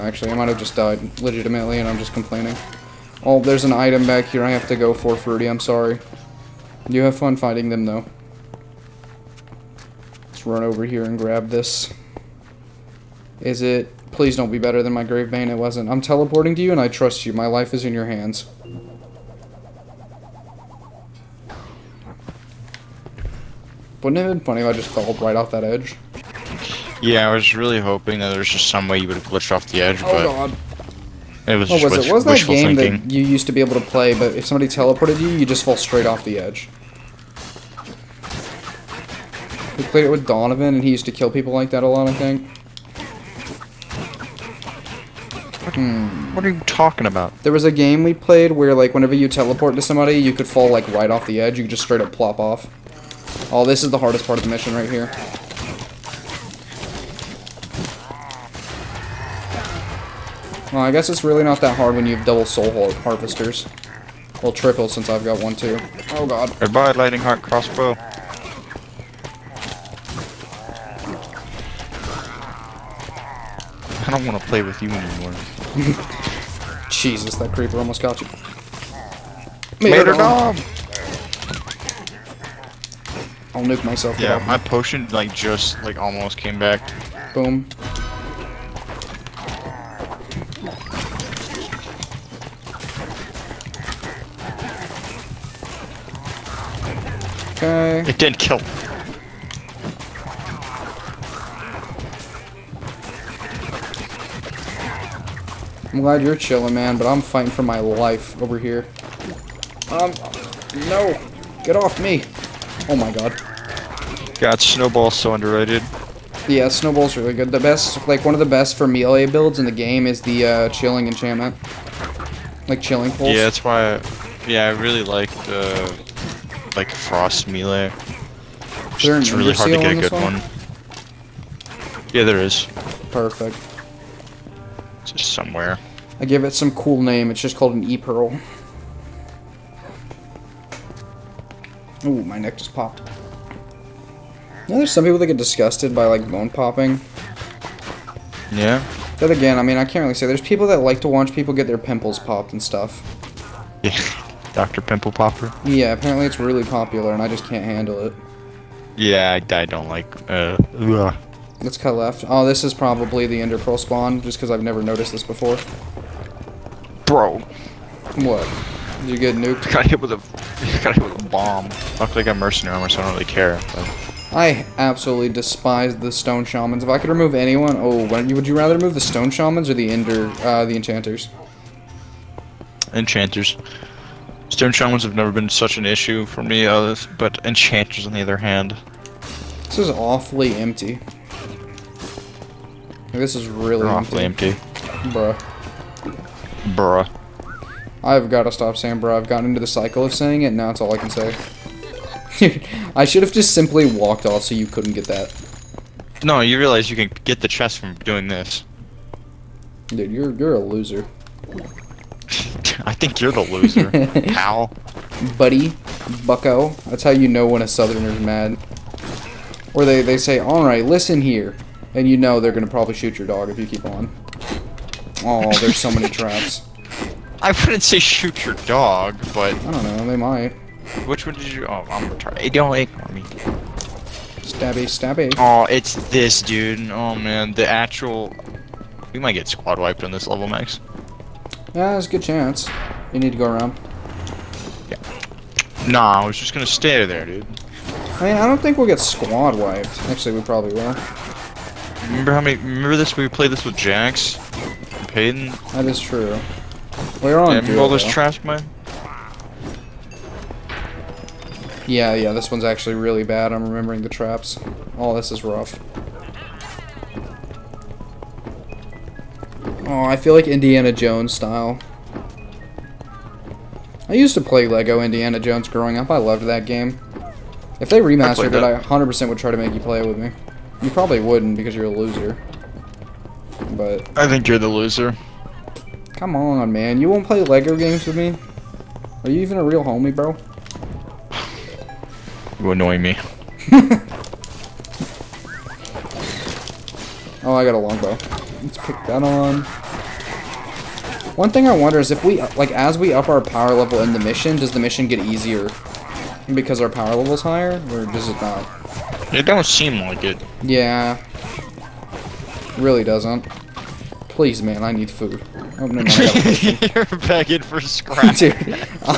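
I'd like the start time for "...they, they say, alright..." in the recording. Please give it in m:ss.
3:39.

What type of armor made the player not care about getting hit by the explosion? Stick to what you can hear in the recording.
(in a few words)
Mercenary armor.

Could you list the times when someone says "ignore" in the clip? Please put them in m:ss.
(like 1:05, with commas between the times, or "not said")
3:52.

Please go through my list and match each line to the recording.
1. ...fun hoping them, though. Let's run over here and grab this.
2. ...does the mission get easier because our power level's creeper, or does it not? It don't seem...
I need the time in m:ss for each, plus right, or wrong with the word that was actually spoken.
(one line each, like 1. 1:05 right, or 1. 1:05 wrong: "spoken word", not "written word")
1. 0:07 wrong: "finding", not "hoping"
2. 5:04 wrong: "higher", not "creeper".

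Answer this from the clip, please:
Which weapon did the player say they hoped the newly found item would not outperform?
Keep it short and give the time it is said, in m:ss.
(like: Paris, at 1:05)
Gravebane, at 0:15.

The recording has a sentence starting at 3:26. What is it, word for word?
No, you realize you can get the chest from doing this.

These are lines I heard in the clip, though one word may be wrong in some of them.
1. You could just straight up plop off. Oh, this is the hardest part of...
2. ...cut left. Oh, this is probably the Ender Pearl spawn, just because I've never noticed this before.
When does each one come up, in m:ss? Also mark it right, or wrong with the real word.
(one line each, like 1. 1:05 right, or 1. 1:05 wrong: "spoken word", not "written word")
1. 0:51 right
2. 2:41 right.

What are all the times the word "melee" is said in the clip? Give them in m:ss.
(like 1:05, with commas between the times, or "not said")
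1:58, 2:07.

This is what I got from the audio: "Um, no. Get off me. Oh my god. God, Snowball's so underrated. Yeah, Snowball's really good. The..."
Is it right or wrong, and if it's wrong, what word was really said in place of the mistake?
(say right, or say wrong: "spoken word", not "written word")
right.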